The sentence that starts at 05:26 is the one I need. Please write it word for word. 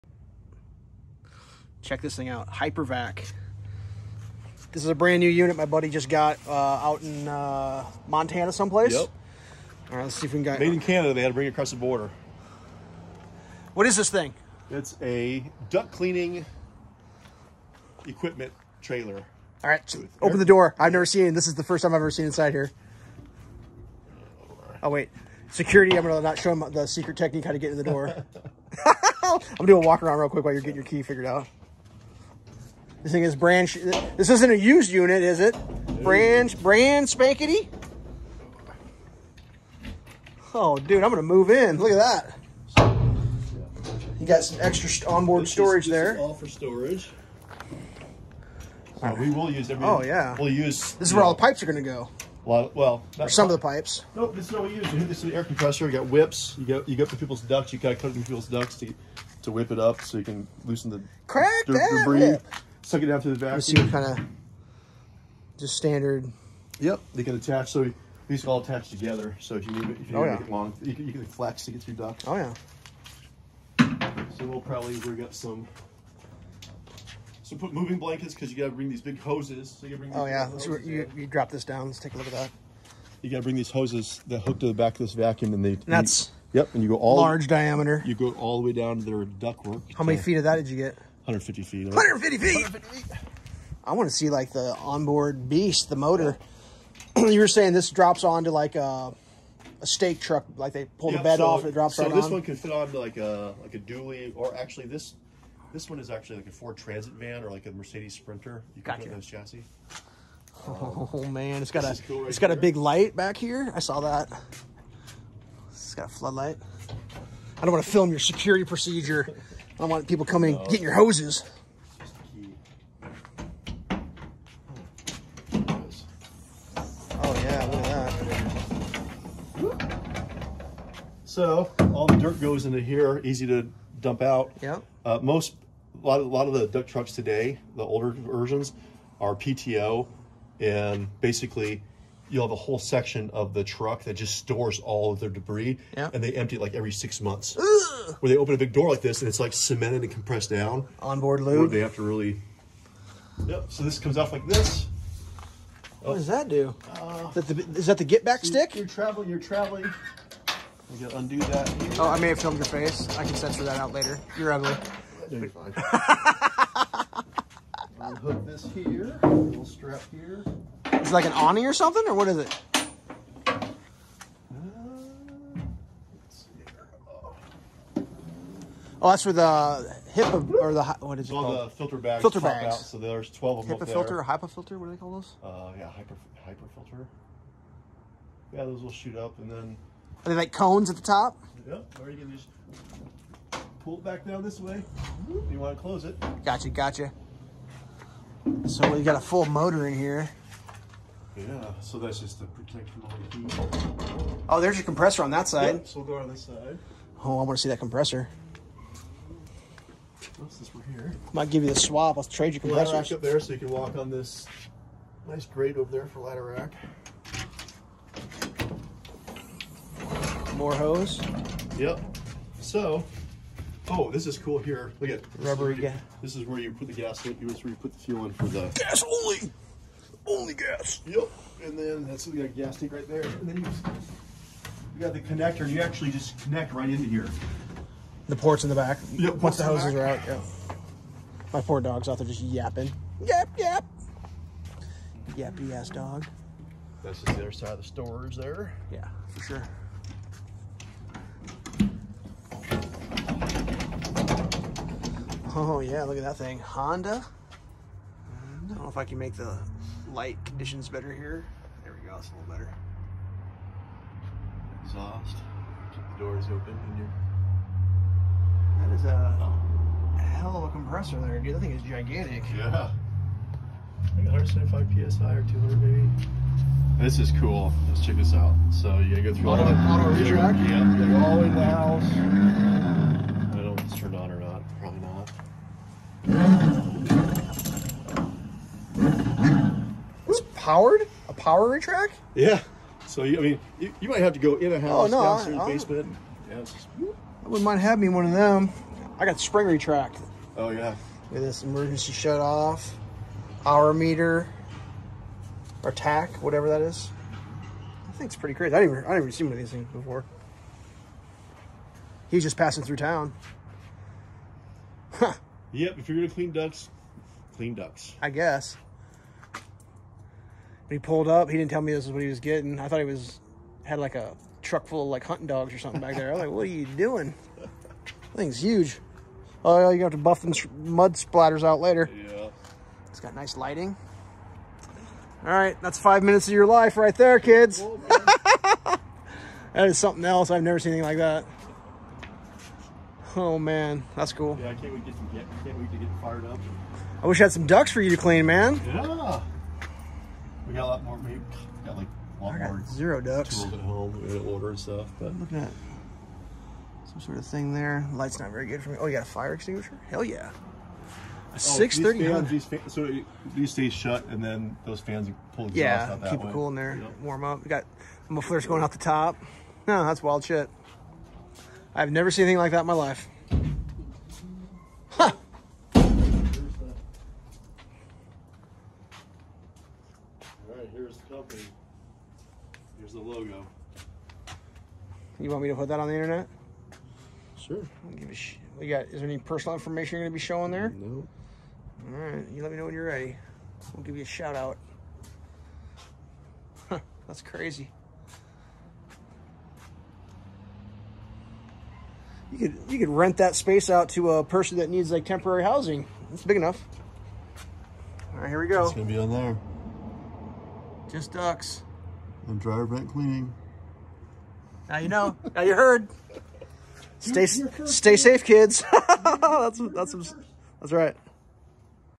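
I was like, what are you doing?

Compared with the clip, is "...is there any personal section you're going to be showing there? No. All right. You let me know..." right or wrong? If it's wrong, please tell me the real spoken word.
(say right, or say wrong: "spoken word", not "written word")
wrong: "information", not "section".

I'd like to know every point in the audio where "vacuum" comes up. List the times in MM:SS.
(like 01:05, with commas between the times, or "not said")
01:03, 01:25.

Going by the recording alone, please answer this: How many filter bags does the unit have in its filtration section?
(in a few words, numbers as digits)
12.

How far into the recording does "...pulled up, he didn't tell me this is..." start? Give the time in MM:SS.
05:21.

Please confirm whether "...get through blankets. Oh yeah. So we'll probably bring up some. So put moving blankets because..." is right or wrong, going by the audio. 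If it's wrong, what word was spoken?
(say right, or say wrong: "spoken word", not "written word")
wrong: "ducts", not "blankets".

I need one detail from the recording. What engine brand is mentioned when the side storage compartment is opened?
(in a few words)
Honda.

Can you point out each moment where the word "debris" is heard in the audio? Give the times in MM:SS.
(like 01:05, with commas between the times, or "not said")
01:02, 02:25.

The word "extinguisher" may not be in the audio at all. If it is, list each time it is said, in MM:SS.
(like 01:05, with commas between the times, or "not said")
05:59.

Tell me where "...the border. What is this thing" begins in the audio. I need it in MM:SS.
00:11.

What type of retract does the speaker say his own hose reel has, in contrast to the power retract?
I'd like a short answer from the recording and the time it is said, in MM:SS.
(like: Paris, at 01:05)
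Spring retract, at 04:59.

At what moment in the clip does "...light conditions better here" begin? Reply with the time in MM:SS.
04:20.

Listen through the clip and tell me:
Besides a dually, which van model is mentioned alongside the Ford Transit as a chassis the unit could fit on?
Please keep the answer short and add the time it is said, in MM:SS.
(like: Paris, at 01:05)
Mercedes Sprinter, at 01:47.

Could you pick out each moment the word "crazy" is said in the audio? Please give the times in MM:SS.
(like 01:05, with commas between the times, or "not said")
05:08, 06:37.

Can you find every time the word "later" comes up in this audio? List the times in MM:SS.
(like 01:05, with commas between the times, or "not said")
02:43, 05:31.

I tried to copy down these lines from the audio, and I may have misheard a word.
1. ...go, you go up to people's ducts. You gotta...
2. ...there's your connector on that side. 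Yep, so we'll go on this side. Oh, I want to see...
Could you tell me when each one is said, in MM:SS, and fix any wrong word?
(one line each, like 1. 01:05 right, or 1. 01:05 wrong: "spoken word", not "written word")
1. 00:56 right
2. 03:24 wrong: "compressor", not "connector".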